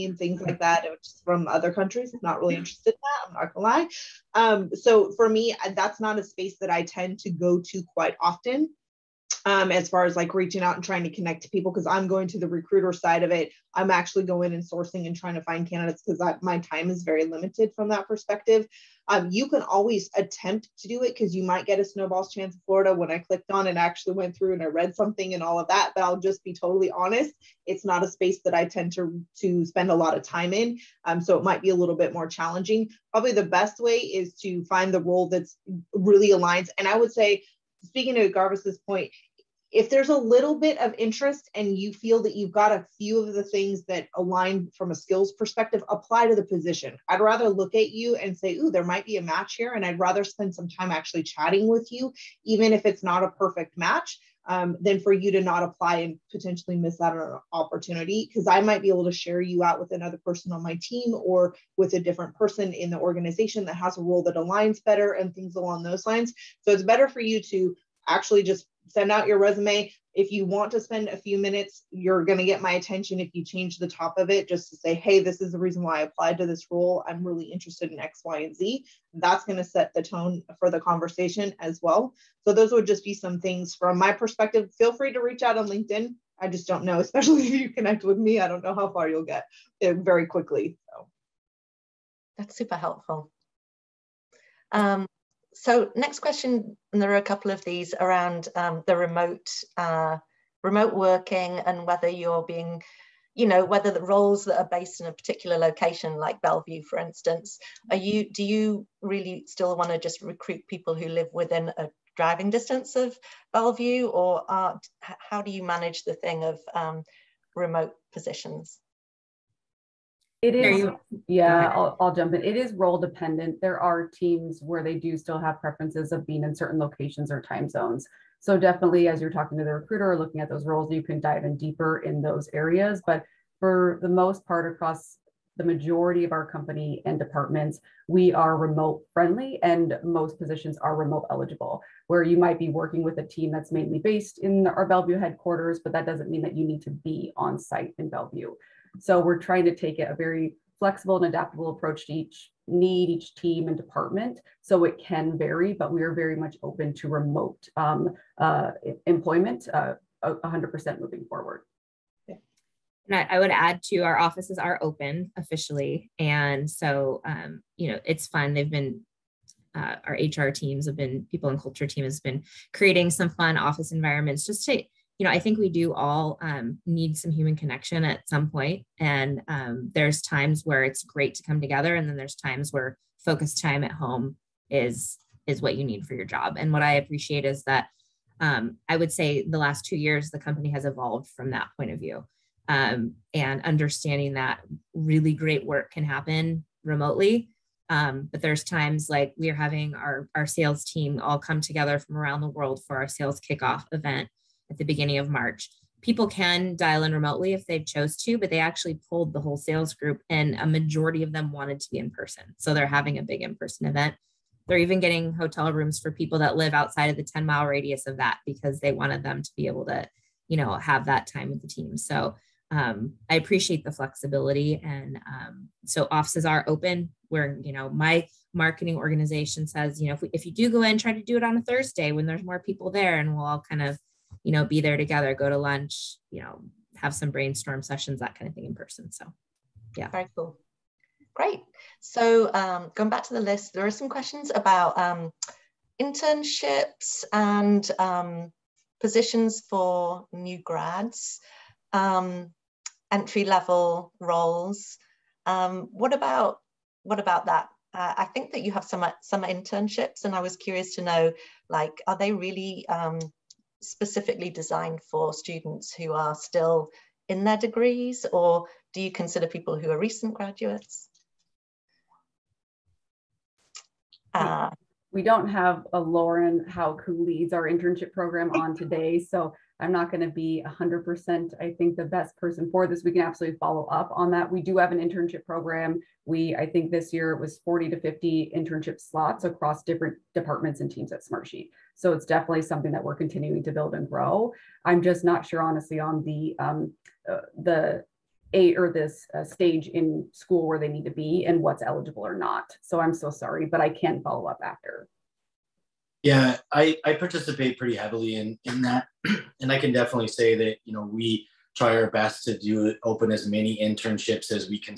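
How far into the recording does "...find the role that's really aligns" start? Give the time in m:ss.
0:34.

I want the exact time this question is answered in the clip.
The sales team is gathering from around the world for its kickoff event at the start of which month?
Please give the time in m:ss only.
3:25.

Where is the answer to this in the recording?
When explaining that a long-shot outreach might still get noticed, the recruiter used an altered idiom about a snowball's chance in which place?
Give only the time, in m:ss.
0:22.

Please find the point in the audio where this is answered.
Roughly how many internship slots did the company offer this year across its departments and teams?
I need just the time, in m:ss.
4:47.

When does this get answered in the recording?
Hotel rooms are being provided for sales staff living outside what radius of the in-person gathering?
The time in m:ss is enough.
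3:37.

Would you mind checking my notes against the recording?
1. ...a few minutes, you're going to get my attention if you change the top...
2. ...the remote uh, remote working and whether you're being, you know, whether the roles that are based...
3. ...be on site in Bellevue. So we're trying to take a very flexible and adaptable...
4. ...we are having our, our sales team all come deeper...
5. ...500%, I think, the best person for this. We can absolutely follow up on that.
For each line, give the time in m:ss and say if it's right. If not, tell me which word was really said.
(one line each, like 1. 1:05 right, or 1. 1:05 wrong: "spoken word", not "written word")
1. 1:11 right
2. 1:38 right
3. 2:26 right
4. 3:19 wrong: "together", not "deeper"
5. 4:40 wrong: "100", not "500".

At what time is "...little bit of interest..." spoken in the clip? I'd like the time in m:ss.
0:40.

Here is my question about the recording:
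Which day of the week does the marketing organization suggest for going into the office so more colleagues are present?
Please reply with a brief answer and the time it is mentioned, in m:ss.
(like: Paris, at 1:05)
Thursday, at 3:51.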